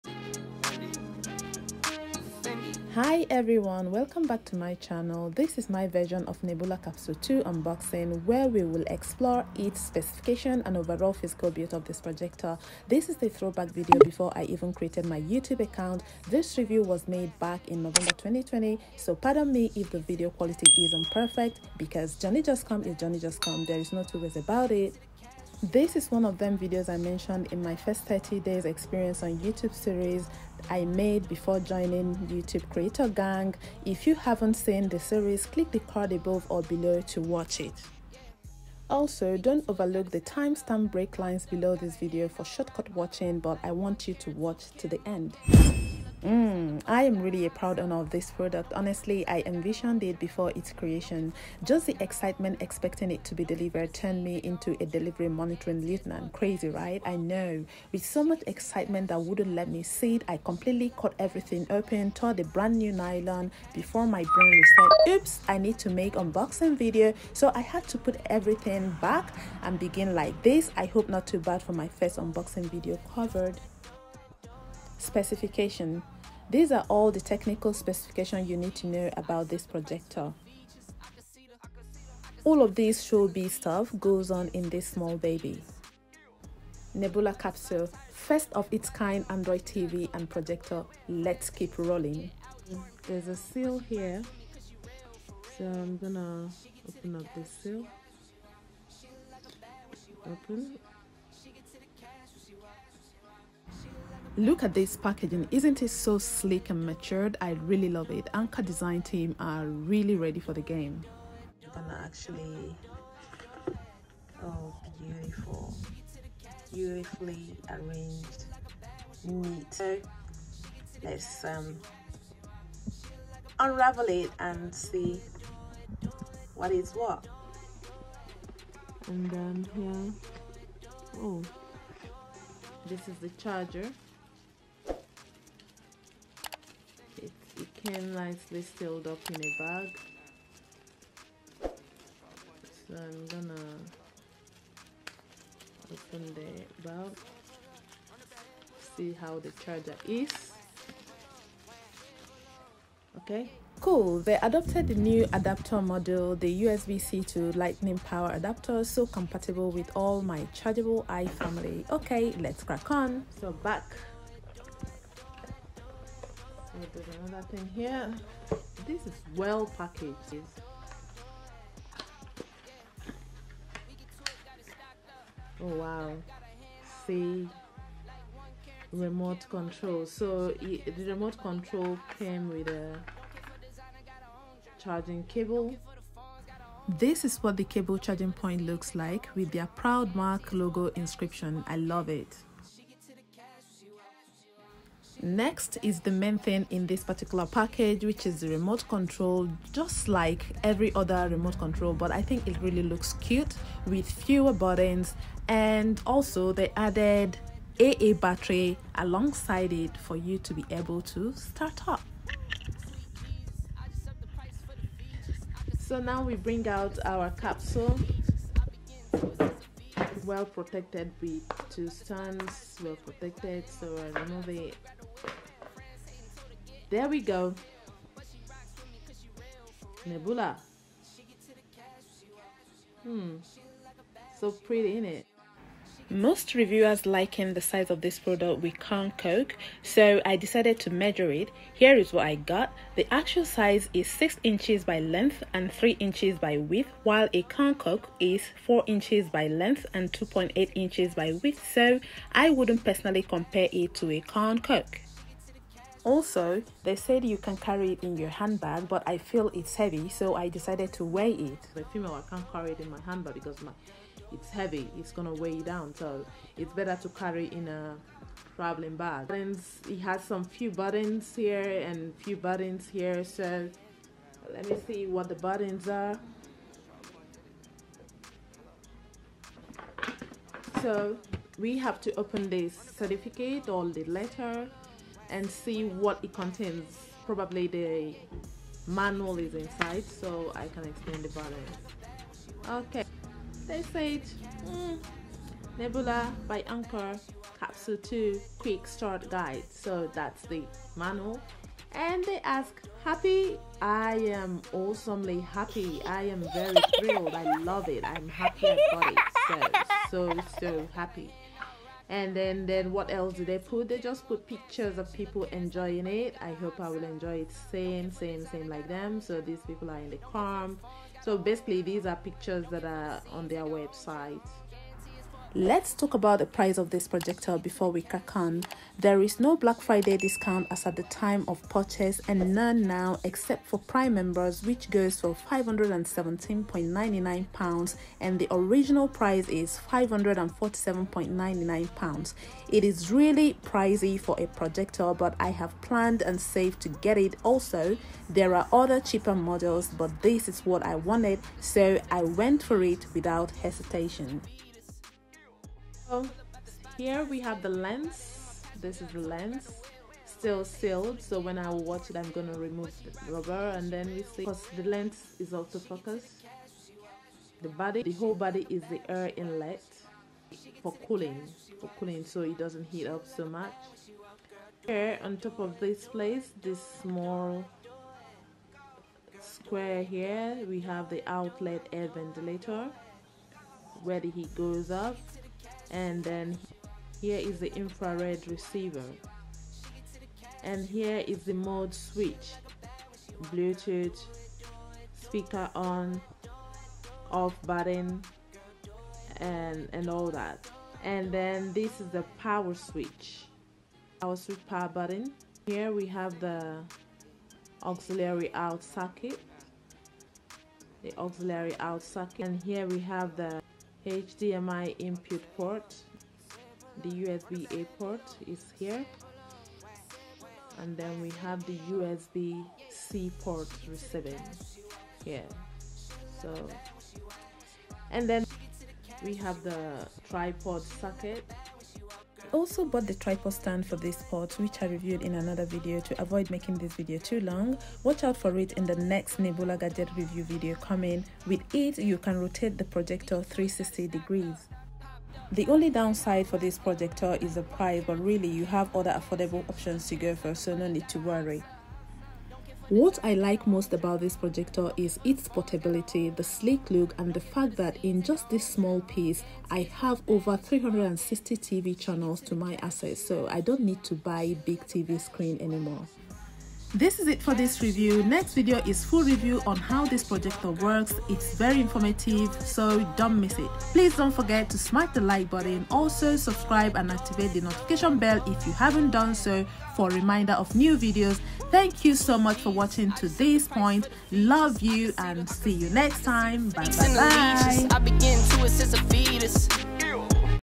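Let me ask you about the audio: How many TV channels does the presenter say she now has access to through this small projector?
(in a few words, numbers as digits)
over 360.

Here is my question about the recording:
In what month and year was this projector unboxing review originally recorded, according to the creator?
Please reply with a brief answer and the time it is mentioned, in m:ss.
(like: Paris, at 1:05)
November 2020, at 0:17.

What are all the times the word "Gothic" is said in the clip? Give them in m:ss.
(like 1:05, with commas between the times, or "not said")
not said.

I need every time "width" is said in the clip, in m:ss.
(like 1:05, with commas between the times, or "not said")
4:06, 4:11.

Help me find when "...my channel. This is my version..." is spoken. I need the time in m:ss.
0:04.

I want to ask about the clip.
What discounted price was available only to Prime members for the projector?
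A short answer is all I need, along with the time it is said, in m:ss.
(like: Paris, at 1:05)
£517.99, at 5:35.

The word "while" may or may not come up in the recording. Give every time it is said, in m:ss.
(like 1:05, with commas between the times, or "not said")
4:07.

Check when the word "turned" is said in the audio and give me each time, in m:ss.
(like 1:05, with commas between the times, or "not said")
0:53.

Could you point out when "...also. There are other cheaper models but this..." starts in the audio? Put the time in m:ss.
5:47.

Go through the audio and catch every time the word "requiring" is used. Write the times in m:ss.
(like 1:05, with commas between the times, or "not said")
not said.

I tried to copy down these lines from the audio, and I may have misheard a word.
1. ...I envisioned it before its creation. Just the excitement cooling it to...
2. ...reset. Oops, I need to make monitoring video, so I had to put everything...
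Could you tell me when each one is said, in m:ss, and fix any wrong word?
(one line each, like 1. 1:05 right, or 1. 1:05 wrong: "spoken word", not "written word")
1. 0:49 wrong: "expecting", not "cooling"
2. 1:04 wrong: "unboxing", not "monitoring".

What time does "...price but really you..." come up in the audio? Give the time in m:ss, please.
7:27.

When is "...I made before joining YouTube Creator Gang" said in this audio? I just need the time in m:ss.
0:30.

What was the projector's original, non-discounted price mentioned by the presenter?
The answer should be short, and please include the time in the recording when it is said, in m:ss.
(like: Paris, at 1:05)
£547.99, at 5:39.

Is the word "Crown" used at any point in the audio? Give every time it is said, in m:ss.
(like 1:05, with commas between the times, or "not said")
3:58, 4:07, 4:14.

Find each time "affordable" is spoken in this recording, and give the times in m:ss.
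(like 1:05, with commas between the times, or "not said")
7:29.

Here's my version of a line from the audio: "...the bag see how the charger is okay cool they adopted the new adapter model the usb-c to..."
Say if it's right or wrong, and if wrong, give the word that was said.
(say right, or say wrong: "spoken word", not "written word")
right.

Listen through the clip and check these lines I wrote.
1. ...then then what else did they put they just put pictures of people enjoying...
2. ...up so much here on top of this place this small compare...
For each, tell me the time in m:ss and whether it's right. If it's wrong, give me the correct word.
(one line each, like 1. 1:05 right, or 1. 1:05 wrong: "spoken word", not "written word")
1. 5:12 right
2. 6:13 wrong: "square", not "compare".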